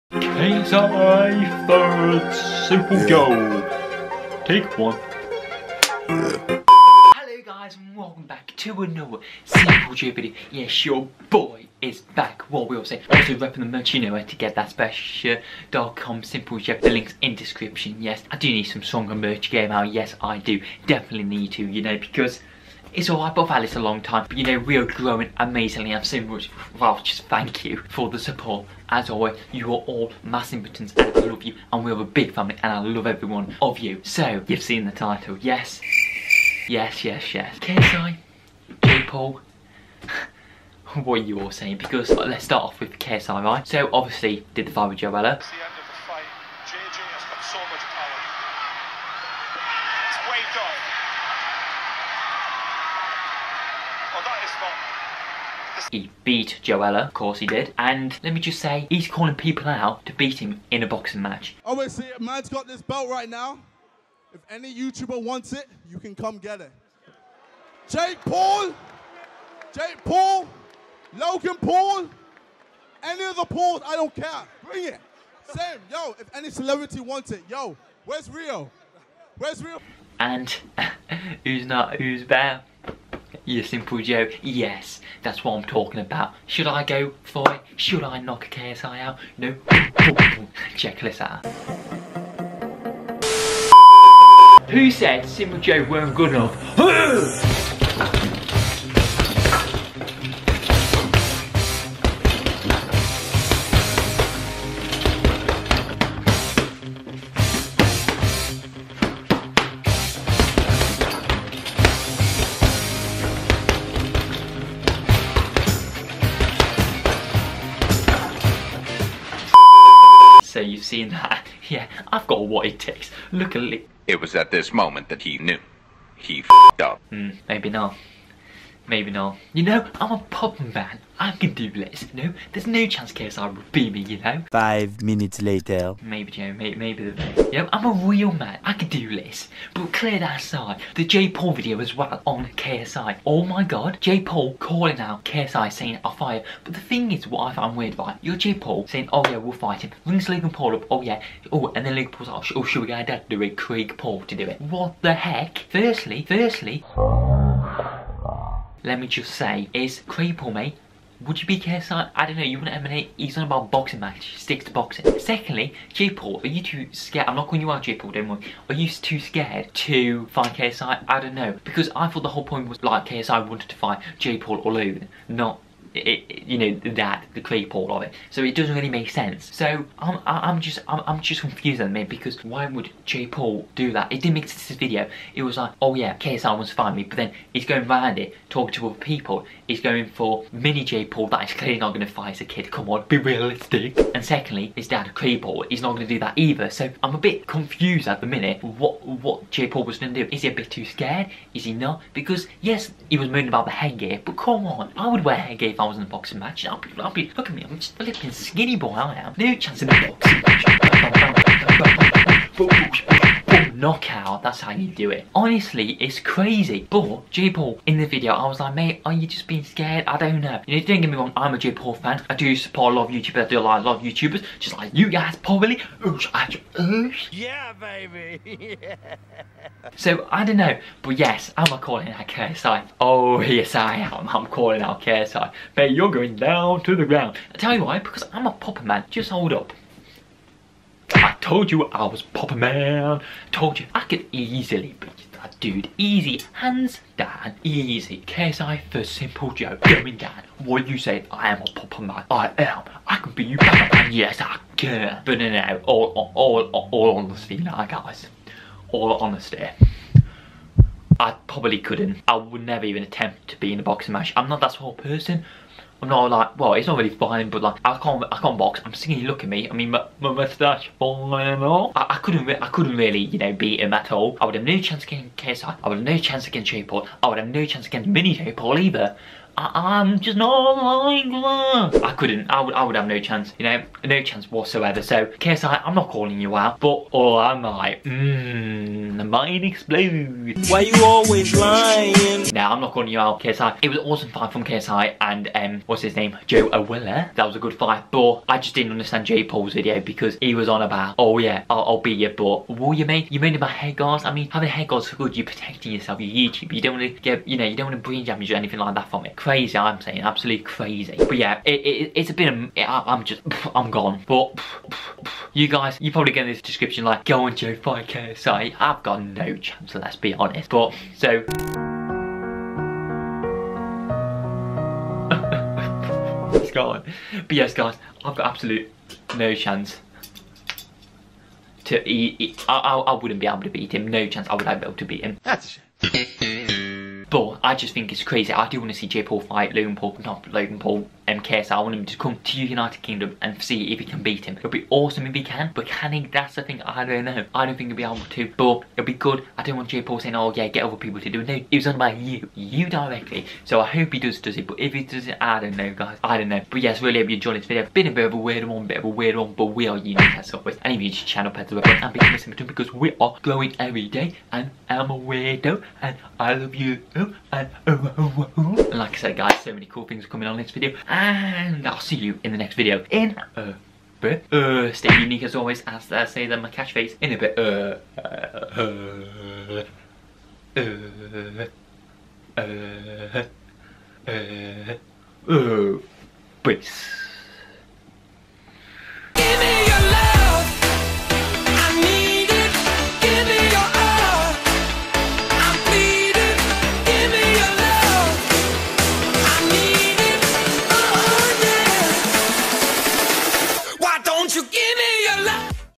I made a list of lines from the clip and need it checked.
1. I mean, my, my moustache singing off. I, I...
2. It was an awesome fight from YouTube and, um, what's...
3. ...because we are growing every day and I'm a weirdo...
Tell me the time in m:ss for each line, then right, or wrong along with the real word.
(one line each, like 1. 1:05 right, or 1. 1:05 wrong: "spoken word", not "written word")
1. 4:29 wrong: "falling", not "singing"
2. 4:53 wrong: "KSI", not "YouTube"
3. 6:02 right.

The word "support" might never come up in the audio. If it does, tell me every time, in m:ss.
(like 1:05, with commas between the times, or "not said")
0:28, 3:42.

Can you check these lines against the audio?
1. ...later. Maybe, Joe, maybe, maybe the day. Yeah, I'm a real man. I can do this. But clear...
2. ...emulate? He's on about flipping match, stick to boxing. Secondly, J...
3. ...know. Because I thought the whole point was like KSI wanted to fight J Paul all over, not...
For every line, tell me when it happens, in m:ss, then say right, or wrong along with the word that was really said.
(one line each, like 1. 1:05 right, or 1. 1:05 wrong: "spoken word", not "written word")
1. 2:15 right
2. 2:42 wrong: "boxing", not "flipping"
3. 2:51 right.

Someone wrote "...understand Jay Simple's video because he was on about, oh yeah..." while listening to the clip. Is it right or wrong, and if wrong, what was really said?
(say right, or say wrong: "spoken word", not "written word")
wrong: "Paul", not "Simple".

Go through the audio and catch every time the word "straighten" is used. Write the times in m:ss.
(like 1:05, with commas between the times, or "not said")
not said.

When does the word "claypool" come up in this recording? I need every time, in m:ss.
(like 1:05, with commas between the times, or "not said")
2:57, 3:15.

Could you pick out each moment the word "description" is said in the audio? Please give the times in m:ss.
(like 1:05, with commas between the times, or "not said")
0:17, 5:16.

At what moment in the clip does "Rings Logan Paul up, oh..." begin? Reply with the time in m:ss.
2:30.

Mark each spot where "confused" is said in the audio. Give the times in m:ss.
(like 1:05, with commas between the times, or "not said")
3:01, 3:17.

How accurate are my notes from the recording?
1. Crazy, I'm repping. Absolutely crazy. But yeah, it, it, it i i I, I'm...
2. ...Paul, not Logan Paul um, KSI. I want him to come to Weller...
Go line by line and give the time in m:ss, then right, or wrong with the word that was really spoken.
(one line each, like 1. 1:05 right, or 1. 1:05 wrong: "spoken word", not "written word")
1. 5:09 wrong: "saying", not "repping"
2. 5:39 wrong: "United", not "Weller".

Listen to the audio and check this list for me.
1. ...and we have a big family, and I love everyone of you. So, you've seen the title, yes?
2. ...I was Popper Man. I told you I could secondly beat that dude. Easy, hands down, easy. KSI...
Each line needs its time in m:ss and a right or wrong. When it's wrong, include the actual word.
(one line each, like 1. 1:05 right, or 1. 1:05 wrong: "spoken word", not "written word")
1. 0:31 right
2. 4:01 wrong: "easily", not "secondly".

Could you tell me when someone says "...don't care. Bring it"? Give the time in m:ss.
1:13.